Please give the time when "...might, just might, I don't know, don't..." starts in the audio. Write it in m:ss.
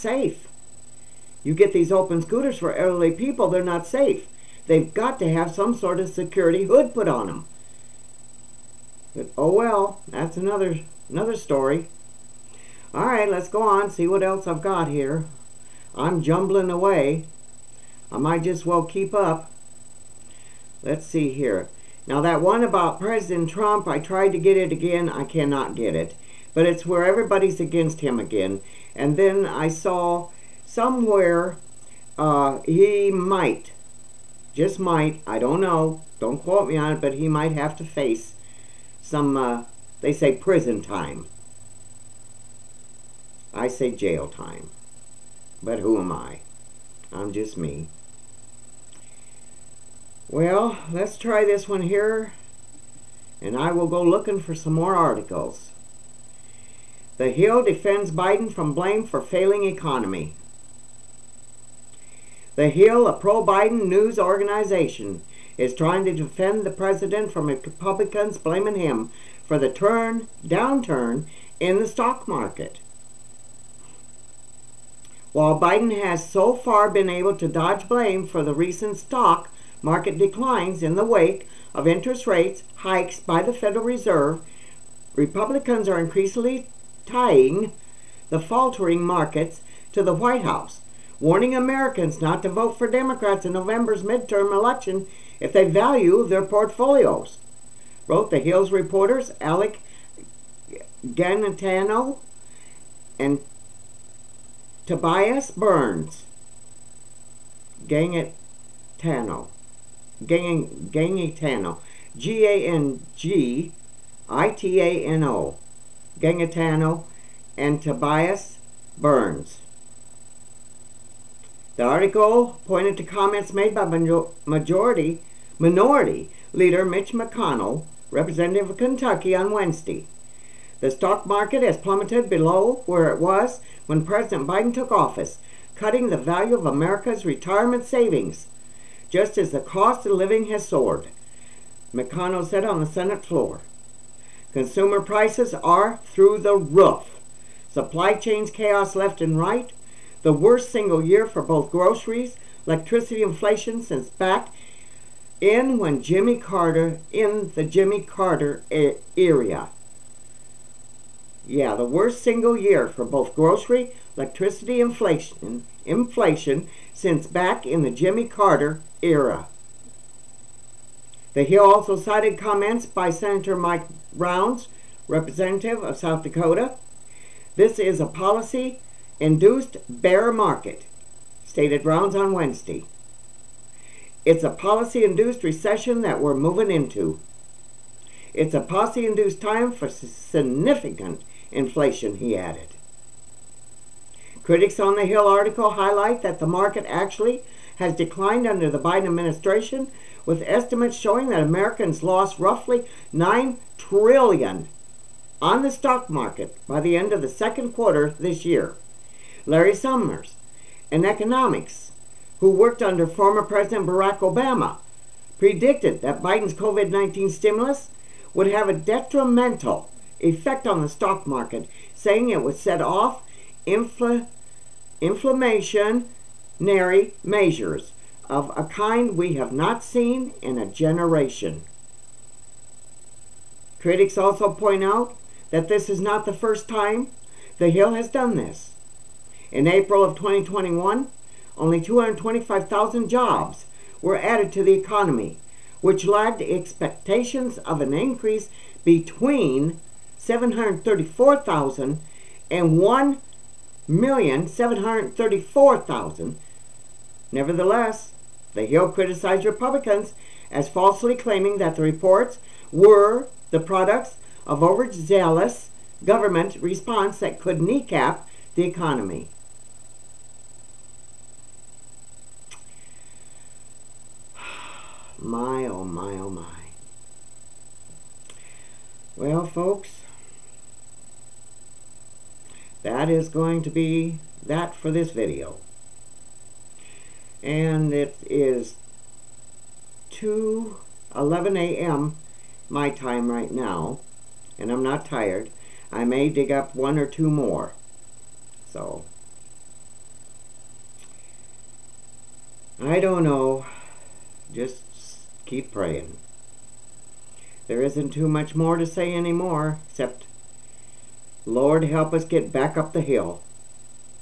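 0:33.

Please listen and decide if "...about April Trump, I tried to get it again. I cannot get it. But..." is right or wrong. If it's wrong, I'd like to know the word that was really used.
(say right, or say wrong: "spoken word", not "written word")
wrong: "President", not "April".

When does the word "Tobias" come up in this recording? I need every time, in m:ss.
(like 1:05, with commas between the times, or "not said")
1:44, 1:57.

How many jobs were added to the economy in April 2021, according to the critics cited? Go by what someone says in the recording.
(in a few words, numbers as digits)
225,000.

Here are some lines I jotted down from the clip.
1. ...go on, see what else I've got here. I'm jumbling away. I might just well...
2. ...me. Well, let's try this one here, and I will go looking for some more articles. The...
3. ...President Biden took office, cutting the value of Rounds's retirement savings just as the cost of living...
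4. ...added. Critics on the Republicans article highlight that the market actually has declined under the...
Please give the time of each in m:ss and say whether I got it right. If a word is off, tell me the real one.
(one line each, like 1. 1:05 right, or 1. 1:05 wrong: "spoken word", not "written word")
1. 0:13 right
2. 0:47 right
3. 2:14 wrong: "America", not "Rounds"
4. 3:12 wrong: "Hill", not "Republicans".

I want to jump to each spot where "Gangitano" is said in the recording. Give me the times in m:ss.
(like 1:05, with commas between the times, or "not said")
1:41, 1:50, 1:56.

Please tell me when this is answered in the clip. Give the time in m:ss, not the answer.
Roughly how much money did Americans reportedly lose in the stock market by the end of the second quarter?
3:23.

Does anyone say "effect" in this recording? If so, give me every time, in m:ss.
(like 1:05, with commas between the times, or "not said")
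3:40.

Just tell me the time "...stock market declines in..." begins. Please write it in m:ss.
1:18.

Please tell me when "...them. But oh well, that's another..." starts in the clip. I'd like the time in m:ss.
0:07.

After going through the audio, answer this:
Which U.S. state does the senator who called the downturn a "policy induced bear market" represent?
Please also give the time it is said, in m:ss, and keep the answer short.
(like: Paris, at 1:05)
South Dakota, at 2:55.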